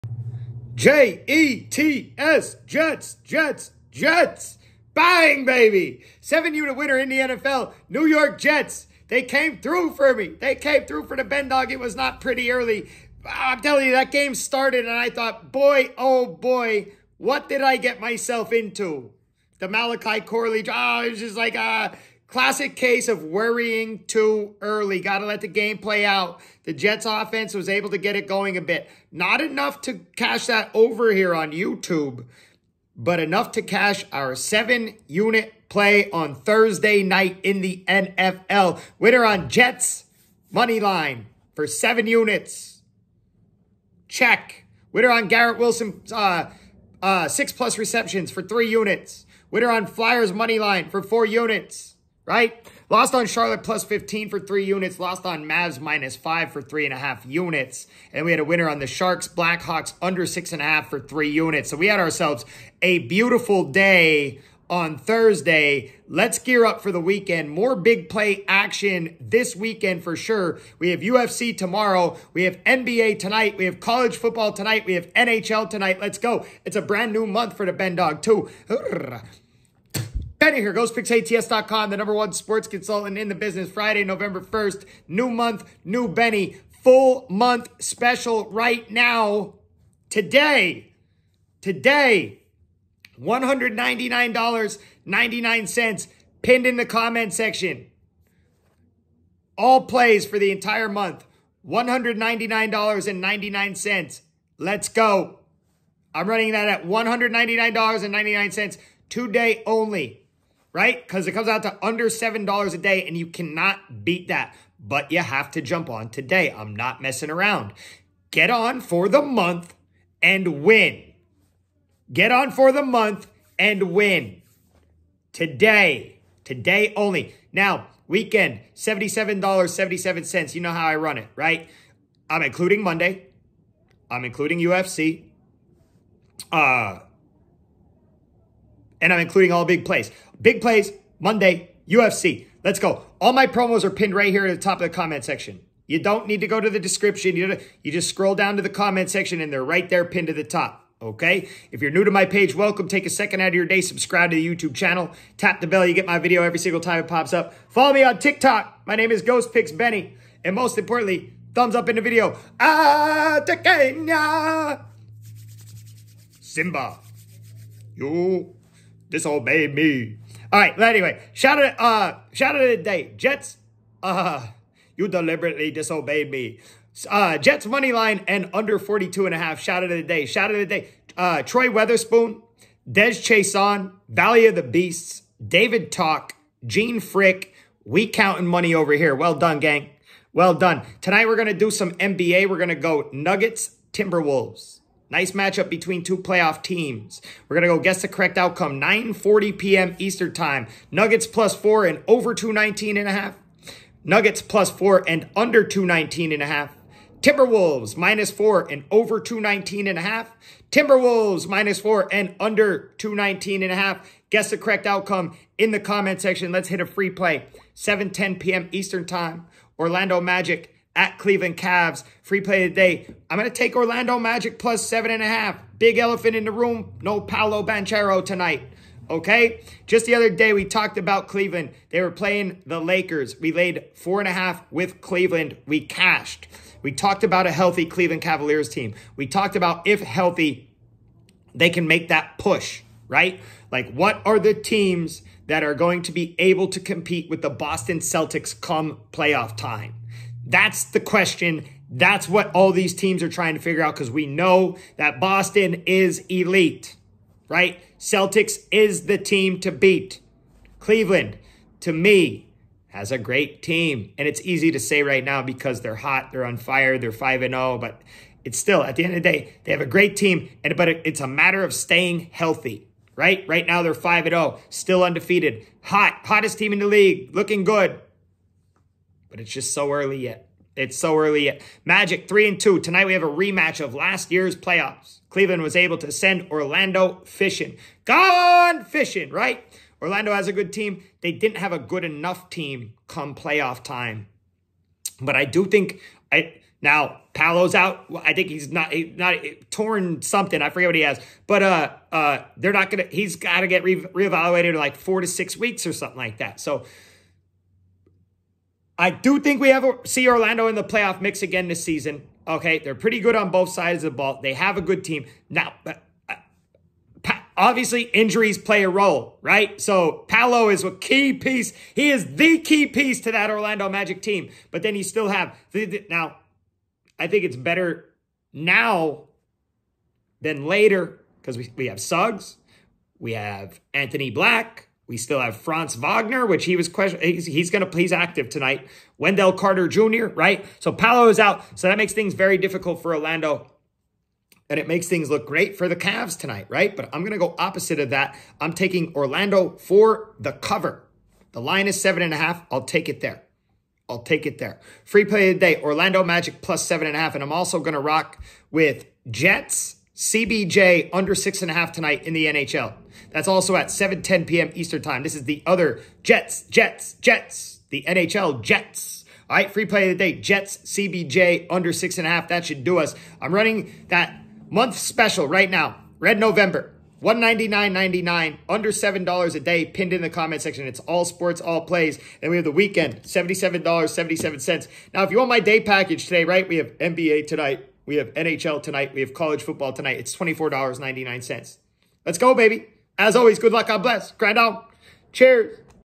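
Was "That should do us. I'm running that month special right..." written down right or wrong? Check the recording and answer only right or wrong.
right.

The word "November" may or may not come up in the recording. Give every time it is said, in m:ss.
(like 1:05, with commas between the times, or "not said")
1:24, 6:16.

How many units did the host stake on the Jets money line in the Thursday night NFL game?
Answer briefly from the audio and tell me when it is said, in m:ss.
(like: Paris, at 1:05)
7, at 0:41.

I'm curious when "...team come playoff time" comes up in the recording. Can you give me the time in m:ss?
4:52.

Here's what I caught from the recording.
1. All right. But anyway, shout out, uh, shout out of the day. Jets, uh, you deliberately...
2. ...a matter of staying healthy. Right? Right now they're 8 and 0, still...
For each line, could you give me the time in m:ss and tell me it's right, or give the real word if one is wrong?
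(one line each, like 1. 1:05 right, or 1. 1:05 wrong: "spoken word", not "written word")
1. 2:50 right
2. 4:31 wrong: "5", not "8".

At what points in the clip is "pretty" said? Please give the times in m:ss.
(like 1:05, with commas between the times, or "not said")
0:12, 5:12.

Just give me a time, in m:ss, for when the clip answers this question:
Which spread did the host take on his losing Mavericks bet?
0:55.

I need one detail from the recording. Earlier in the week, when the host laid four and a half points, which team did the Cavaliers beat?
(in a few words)
Lakers.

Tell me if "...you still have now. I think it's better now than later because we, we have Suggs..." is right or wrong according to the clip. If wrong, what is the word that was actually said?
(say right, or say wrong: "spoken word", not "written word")
right.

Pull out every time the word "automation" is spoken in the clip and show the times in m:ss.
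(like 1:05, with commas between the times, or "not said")
not said.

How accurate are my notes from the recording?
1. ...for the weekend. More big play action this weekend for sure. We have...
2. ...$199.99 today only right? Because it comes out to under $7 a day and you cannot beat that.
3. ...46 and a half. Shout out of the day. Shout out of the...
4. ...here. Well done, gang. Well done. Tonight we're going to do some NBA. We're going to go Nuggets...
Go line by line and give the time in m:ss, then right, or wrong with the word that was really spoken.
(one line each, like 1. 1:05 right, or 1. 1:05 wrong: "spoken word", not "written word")
1. 1:06 right
2. 1:46 right
3. 2:58 wrong: "42", not "46"
4. 3:08 right.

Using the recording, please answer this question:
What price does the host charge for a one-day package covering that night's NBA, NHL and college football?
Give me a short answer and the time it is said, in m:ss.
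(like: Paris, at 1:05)
$24.99, at 6:30.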